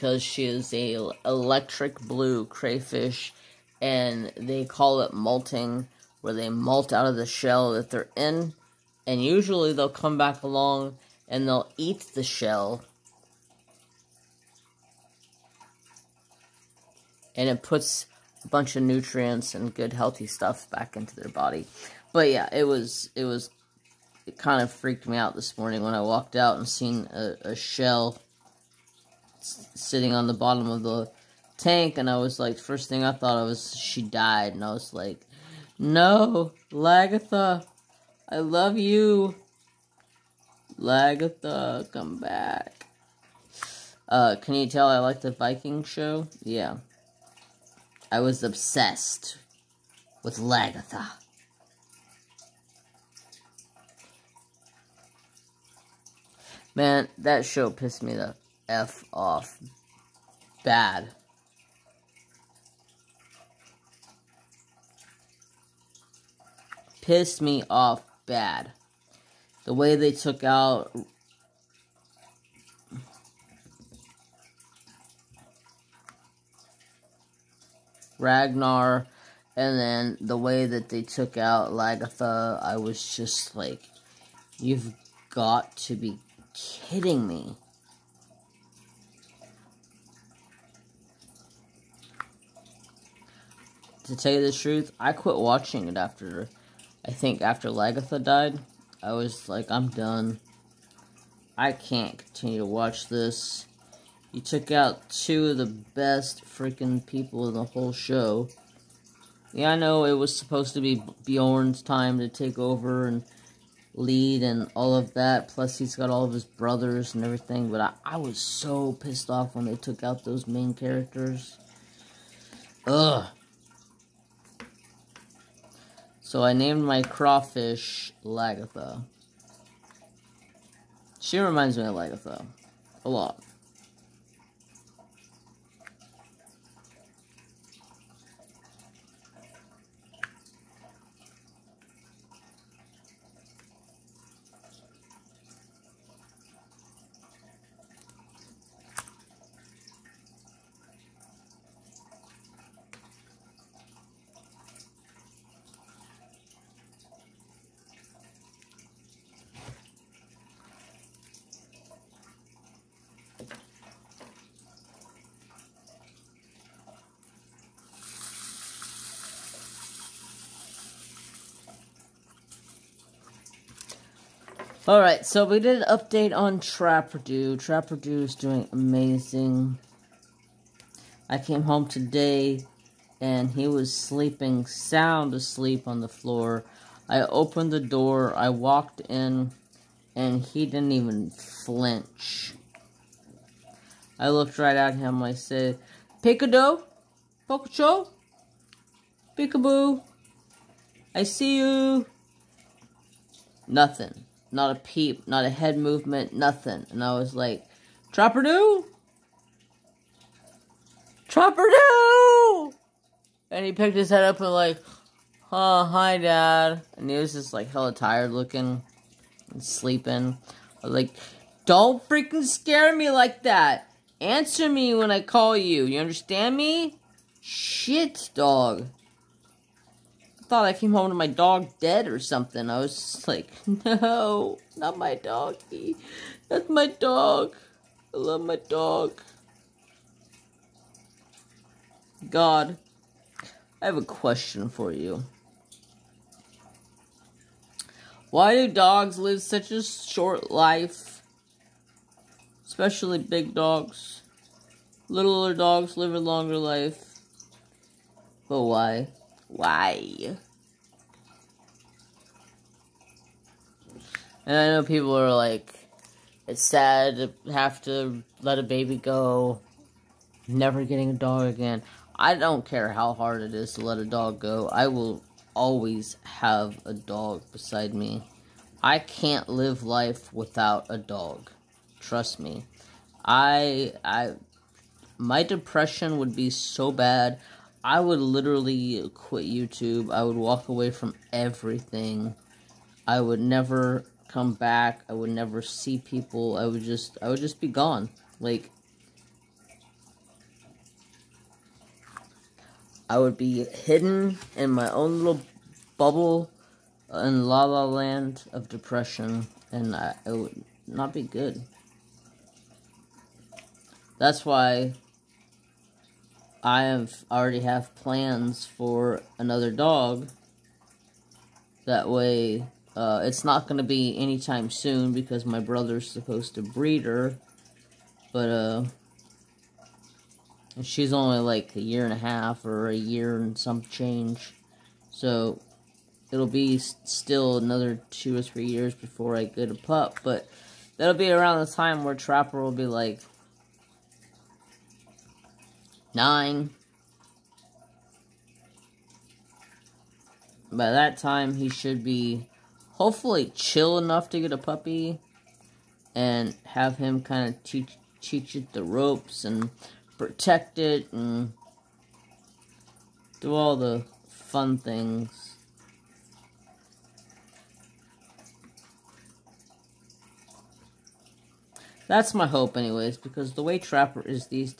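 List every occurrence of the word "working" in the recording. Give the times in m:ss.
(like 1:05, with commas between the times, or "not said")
not said.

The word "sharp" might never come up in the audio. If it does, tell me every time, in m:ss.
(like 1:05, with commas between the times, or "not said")
not said.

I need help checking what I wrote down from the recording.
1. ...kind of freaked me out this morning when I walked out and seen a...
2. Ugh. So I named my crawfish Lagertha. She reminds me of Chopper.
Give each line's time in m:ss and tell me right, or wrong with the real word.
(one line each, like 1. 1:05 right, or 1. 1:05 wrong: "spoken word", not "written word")
1. 0:24 right
2. 2:02 wrong: "Lagertha", not "Chopper".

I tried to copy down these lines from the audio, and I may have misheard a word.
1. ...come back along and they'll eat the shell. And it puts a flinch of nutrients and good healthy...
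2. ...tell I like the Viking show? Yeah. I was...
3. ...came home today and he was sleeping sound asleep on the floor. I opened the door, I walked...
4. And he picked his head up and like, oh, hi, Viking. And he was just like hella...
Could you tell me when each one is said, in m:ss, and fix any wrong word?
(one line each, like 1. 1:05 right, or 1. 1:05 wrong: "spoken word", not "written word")
1. 0:09 wrong: "bunch", not "flinch"
2. 0:44 right
3. 3:01 right
4. 3:33 wrong: "Dad", not "Viking".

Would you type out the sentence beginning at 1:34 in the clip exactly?
To tell you the truth, I quit watching it after I think after Lagertha died, I was like, I'm done.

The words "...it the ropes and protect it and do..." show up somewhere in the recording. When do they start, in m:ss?
5:58.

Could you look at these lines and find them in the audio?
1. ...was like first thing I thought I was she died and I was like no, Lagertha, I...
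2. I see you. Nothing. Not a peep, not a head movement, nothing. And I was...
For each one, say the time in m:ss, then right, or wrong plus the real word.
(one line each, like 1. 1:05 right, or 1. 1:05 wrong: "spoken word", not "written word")
1. 0:32 right
2. 3:21 right.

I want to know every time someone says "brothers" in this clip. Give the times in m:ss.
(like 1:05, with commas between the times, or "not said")
1:56, 5:25.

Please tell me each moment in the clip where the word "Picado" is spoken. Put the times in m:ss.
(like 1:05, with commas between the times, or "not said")
3:16.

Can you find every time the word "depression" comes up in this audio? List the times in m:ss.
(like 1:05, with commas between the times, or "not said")
4:45, 5:08.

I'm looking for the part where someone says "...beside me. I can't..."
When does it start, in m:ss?
4:37.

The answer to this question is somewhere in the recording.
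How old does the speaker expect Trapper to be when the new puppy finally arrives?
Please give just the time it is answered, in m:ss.
5:46.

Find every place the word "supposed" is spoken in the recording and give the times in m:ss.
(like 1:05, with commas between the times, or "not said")
1:50, 5:26.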